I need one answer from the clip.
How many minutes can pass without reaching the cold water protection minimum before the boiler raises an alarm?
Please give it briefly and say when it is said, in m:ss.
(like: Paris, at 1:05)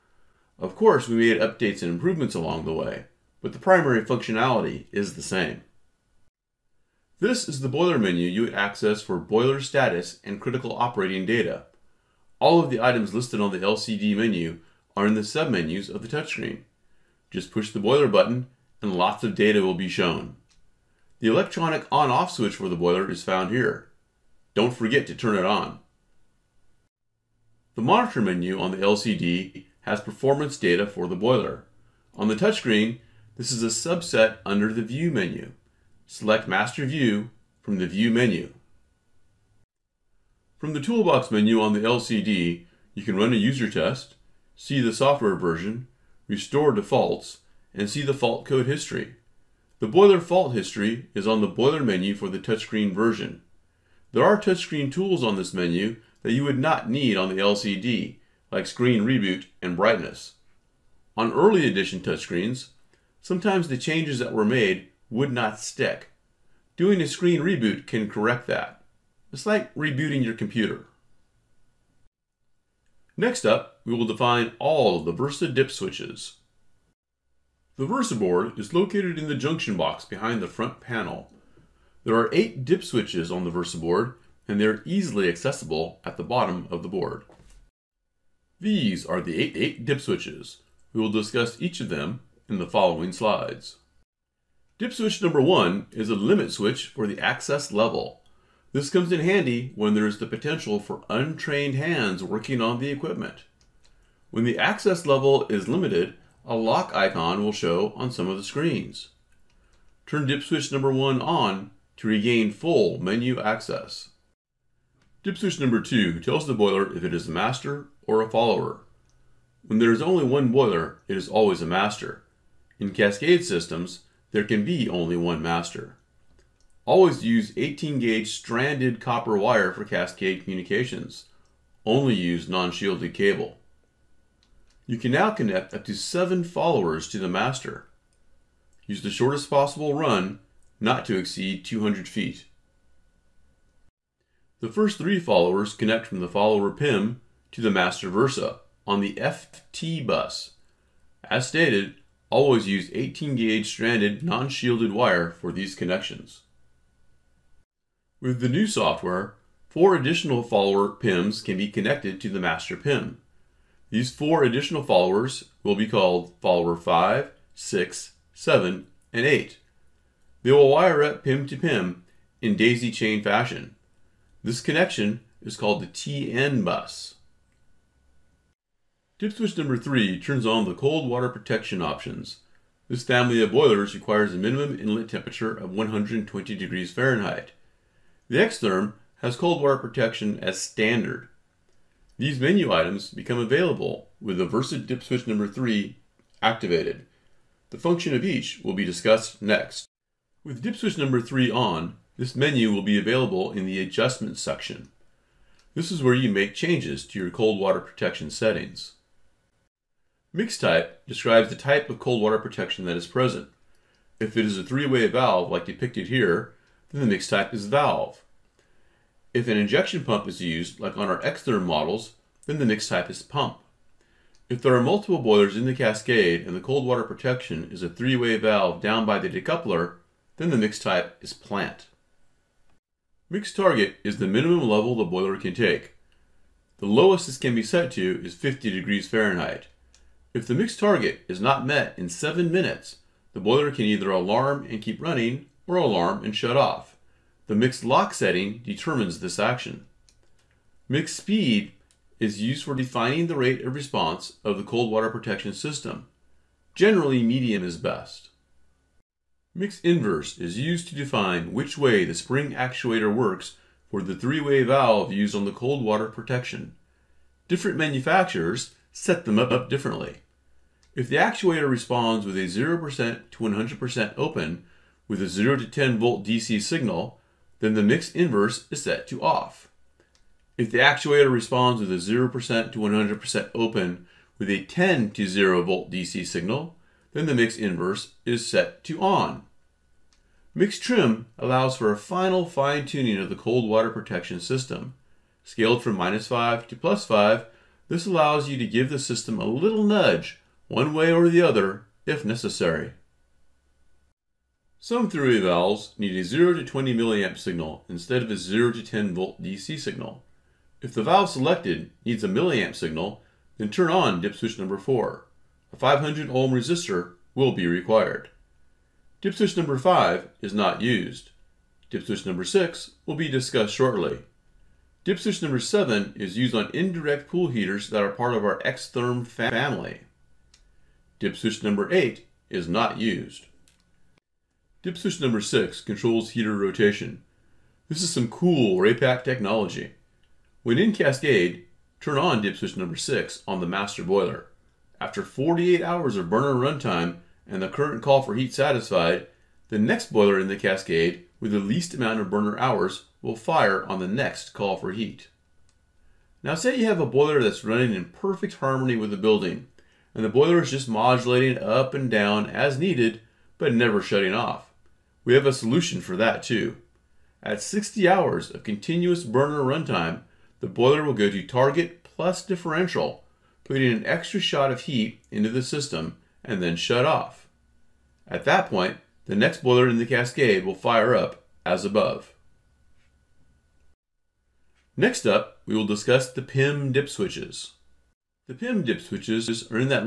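7, at 4:02.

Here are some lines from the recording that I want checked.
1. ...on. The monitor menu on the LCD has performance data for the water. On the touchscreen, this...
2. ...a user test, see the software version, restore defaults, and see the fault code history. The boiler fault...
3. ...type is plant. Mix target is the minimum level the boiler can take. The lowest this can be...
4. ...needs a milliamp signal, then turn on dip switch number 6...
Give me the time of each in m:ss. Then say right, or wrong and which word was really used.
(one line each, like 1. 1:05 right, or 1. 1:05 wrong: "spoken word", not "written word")
1. 0:25 wrong: "boiler", not "water"
2. 0:43 right
3. 3:50 right
4. 5:12 wrong: "4", not "6".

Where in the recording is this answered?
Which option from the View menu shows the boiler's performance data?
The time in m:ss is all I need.
0:36.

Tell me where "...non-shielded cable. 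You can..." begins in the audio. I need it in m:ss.
2:12.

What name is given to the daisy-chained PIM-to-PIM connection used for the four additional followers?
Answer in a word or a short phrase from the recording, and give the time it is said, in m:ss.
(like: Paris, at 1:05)
TN bus, at 2:55.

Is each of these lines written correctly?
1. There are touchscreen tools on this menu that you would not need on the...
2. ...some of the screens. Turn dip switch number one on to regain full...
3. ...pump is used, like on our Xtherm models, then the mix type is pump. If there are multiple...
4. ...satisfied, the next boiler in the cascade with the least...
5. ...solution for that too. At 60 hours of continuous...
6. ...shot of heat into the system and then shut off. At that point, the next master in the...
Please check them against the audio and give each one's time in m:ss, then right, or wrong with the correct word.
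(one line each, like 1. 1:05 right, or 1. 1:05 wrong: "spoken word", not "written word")
1. 0:54 right
2. 1:48 right
3. 3:40 right
4. 5:48 right
5. 6:05 right
6. 6:14 wrong: "boiler", not "master".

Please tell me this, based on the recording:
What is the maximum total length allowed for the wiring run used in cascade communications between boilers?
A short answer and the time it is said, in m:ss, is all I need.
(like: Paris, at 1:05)
200 feet, at 2:21.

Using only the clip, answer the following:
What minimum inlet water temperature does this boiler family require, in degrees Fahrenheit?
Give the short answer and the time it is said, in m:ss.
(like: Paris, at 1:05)
120, at 3:05.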